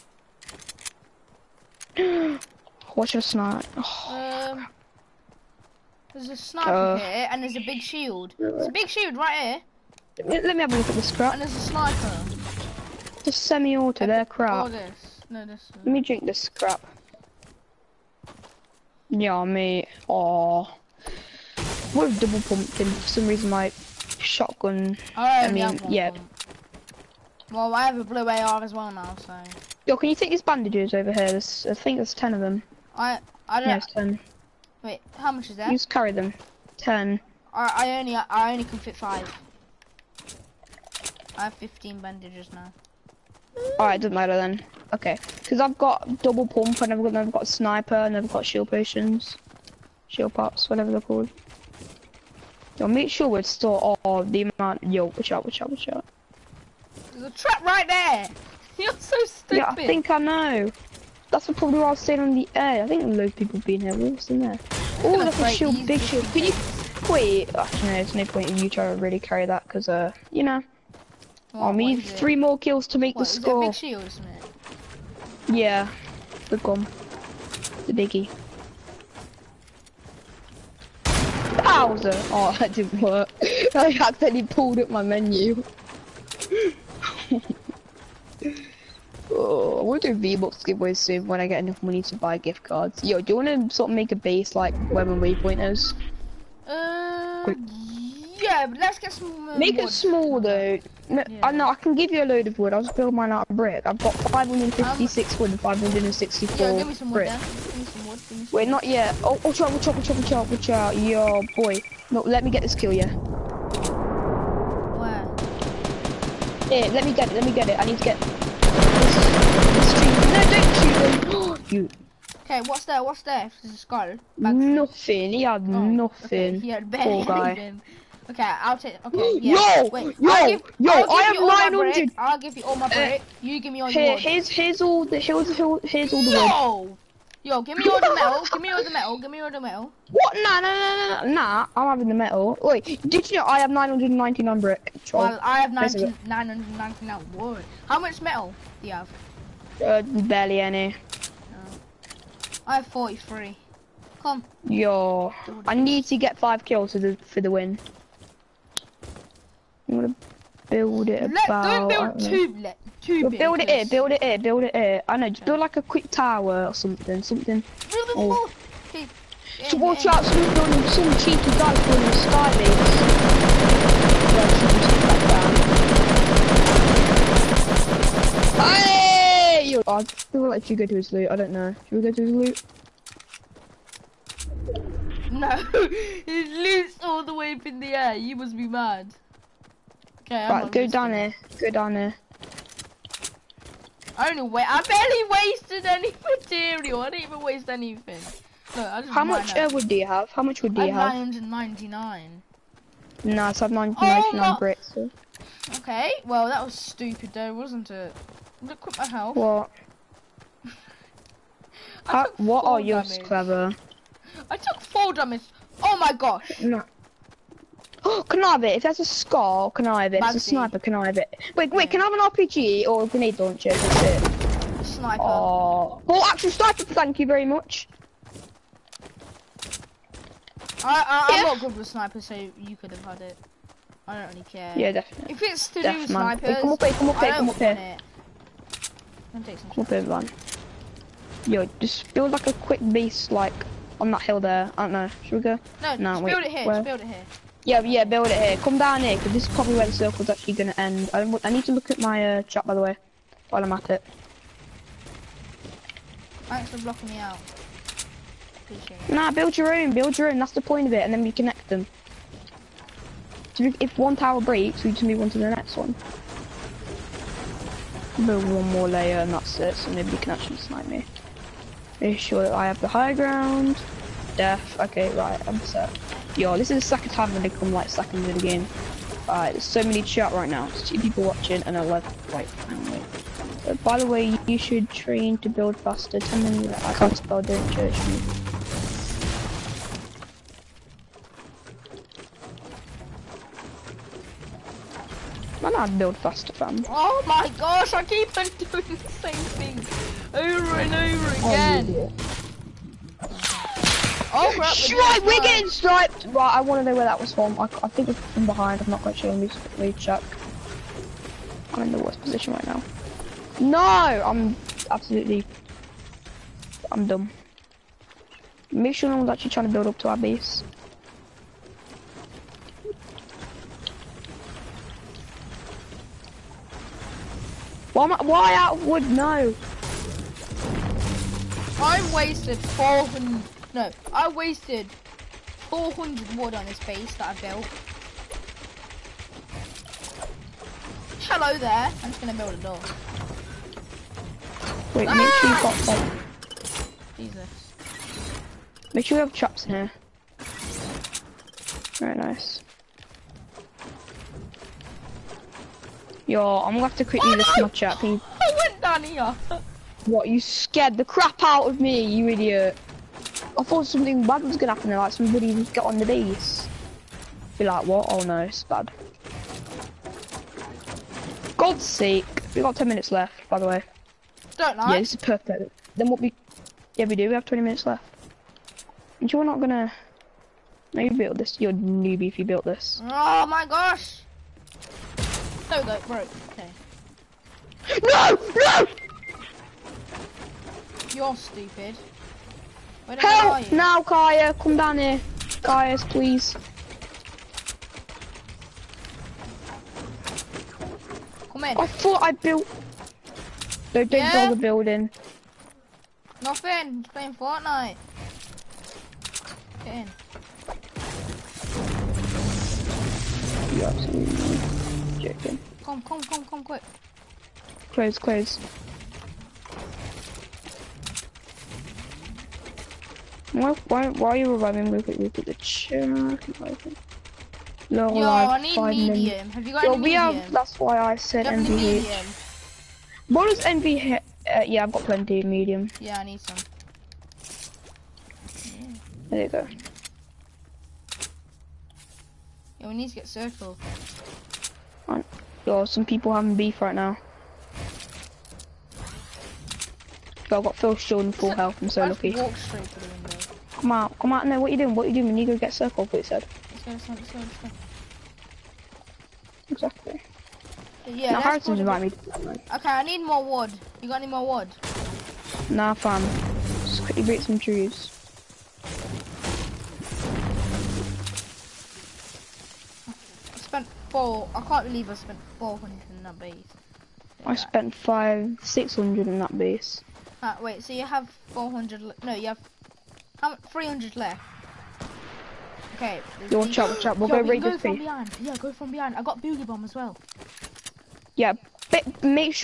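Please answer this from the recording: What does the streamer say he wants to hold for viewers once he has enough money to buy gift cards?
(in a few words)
V-Bucks giveaways.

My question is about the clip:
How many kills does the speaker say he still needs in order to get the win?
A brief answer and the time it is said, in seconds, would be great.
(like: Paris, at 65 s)
5, at 156 s.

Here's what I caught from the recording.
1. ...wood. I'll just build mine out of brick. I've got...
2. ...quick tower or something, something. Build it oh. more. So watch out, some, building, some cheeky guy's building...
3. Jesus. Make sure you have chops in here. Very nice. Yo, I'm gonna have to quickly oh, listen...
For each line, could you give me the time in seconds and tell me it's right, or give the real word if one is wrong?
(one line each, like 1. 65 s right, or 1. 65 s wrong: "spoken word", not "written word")
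1. 102 s right
2. 165 s right
3. 347 s right.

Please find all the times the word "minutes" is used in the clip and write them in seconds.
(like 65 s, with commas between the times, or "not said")
372 s, 377 s.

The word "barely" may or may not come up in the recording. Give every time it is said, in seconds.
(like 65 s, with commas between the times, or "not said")
126 s, 150 s, 194 s.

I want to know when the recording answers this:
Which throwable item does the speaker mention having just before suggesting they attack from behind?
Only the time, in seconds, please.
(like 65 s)
489 s.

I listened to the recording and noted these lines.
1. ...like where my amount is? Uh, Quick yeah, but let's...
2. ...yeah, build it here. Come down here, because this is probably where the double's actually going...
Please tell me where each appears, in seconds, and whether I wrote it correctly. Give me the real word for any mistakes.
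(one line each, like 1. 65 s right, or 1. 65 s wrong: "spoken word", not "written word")
1. 94 s wrong: "waypoint", not "amount"
2. 247 s wrong: "circle", not "double".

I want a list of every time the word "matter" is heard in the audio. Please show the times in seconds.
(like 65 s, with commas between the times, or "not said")
44 s.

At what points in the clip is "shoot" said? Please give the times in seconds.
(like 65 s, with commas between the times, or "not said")
120 s.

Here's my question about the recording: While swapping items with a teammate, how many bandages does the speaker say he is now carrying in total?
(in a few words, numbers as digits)
15.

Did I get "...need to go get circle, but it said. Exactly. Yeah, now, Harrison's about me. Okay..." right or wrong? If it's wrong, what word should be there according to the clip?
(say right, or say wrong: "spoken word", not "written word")
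right.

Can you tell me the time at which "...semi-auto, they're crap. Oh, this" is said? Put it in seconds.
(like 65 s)
13 s.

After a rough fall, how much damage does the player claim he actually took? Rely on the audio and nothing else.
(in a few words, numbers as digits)
4.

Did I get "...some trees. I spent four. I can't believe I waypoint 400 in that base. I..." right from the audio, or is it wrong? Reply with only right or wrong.
wrong.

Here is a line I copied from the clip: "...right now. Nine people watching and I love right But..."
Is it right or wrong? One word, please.
wrong.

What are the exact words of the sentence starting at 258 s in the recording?
Appreciate Nah, build your own, build your own.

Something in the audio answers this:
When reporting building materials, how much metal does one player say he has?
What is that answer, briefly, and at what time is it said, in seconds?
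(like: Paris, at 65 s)
43, at 152 s.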